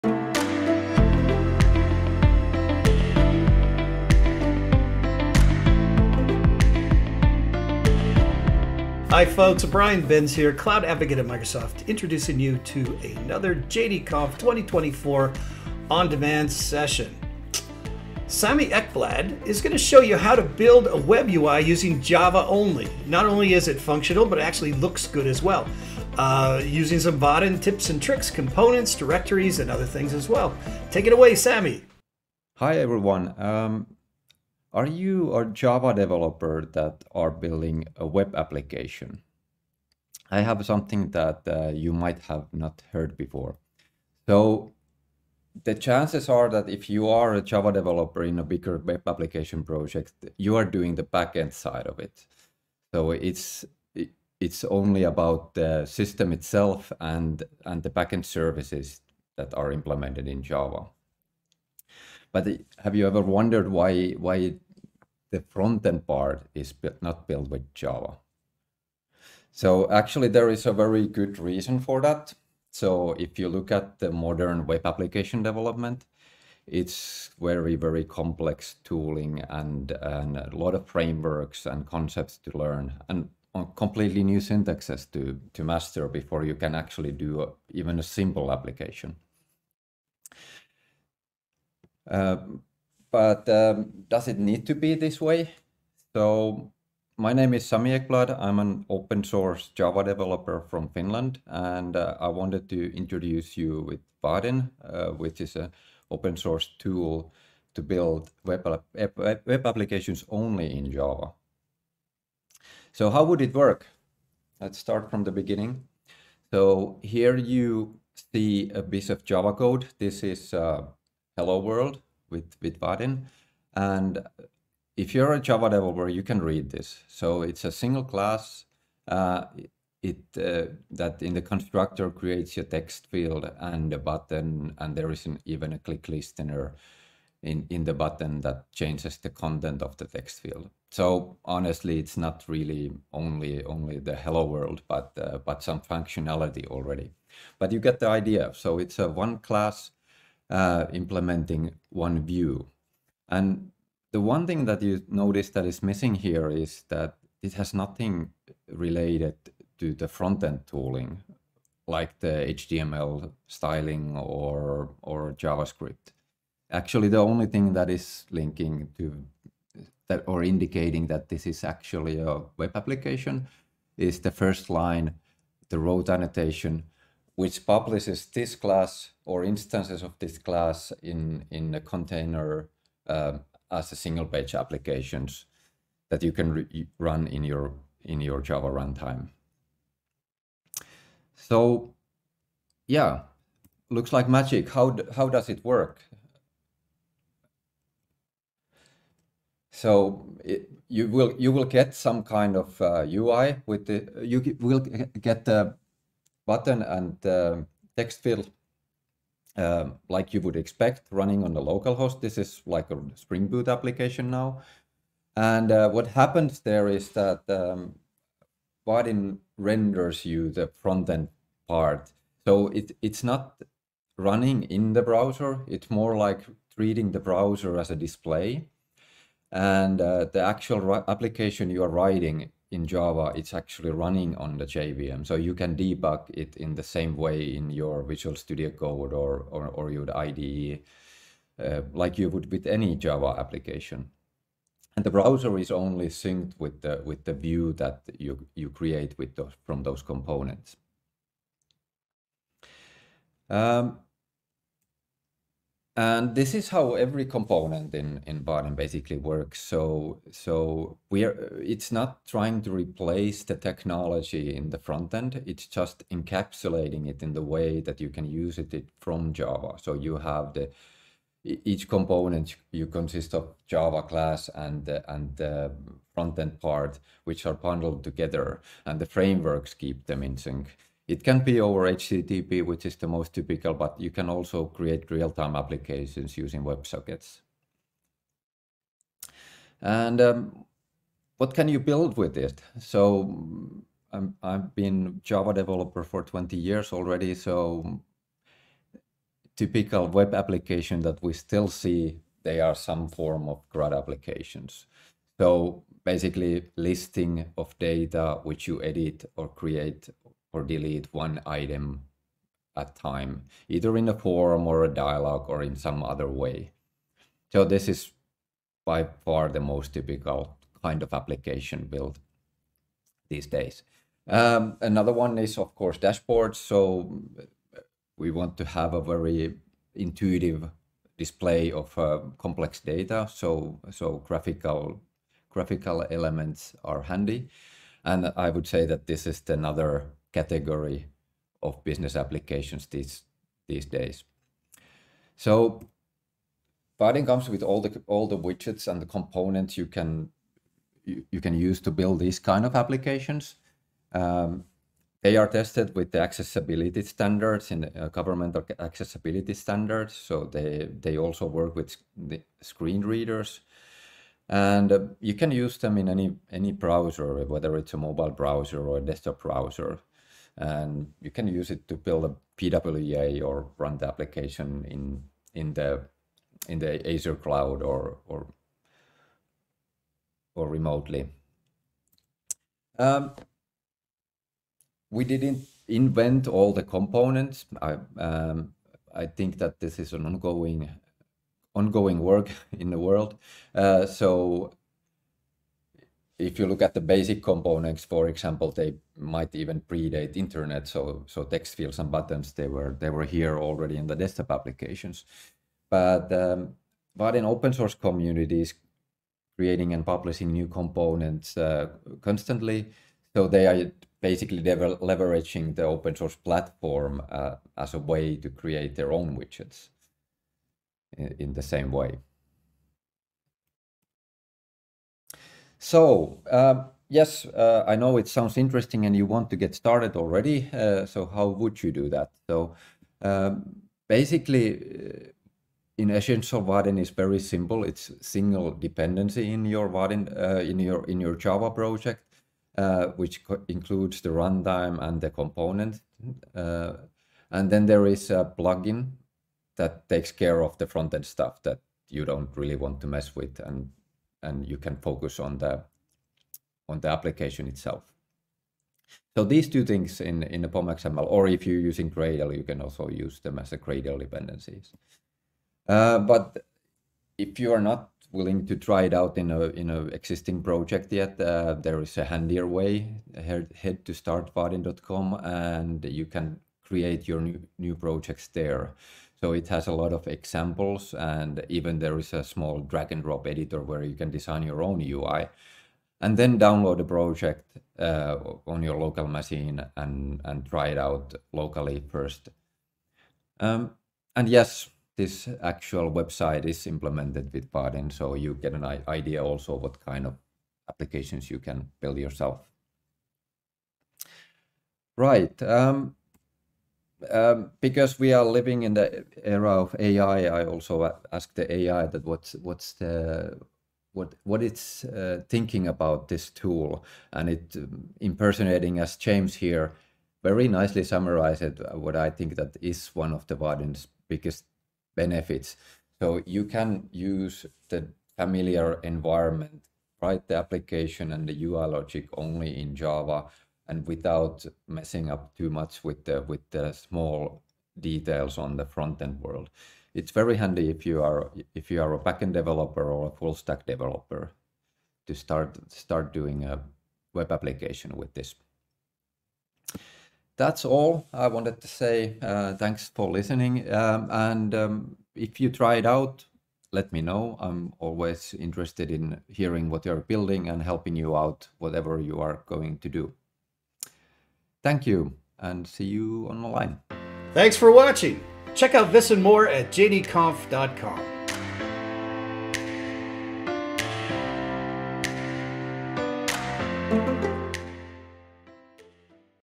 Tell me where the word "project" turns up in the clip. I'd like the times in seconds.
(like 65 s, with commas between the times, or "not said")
49 s, 441 s, 470 s, 477 s, 487 s.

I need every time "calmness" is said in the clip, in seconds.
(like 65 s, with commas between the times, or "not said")
not said.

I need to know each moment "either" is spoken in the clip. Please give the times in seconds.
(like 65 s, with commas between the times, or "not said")
313 s.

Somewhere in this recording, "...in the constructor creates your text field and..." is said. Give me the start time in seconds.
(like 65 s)
131 s.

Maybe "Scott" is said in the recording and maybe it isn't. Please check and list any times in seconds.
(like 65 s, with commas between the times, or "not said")
not said.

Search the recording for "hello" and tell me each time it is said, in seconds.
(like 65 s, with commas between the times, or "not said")
121 s, 144 s.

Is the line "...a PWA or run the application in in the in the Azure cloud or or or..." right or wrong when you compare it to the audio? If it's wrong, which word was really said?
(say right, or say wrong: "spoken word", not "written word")
right.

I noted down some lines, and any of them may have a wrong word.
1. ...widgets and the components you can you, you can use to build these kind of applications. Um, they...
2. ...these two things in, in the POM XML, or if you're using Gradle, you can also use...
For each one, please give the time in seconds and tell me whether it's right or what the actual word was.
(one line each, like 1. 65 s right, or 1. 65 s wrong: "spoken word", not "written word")
1. 348 s right
2. 459 s right.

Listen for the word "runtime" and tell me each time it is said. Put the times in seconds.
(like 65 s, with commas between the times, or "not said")
188 s, 444 s.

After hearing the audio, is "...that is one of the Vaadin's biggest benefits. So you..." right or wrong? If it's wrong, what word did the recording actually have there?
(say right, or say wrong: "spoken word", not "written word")
right.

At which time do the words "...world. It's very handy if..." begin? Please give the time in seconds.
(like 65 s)
539 s.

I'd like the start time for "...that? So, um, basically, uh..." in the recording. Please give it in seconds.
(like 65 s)
432 s.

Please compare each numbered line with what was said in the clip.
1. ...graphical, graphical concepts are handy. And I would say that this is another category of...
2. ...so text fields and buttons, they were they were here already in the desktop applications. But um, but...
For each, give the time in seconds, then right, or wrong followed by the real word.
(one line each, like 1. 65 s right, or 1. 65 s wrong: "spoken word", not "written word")
1. 334 s wrong: "elements", not "concepts"
2. 401 s right.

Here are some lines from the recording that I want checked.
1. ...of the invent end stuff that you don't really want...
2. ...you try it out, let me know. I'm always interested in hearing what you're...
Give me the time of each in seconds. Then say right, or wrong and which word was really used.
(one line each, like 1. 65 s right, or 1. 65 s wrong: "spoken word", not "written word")
1. 450 s wrong: "front", not "invent"
2. 555 s right.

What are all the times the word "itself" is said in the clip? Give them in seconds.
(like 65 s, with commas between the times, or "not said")
56 s, 457 s.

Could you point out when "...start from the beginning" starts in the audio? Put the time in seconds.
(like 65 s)
114 s.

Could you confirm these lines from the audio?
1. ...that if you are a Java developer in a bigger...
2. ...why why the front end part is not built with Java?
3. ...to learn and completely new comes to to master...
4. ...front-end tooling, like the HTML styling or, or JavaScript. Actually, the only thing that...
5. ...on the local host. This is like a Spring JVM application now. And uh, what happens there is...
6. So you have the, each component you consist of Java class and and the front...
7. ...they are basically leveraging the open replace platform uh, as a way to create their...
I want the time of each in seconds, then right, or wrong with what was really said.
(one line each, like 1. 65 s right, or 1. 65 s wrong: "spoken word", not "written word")
1. 46 s right
2. 63 s right
3. 82 s wrong: "syntaxes", not "comes"
4. 160 s right
5. 211 s wrong: "Boot", not "JVM"
6. 269 s right
7. 413 s wrong: "source", not "replace".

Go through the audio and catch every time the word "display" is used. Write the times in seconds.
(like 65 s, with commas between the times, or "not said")
227 s, 331 s.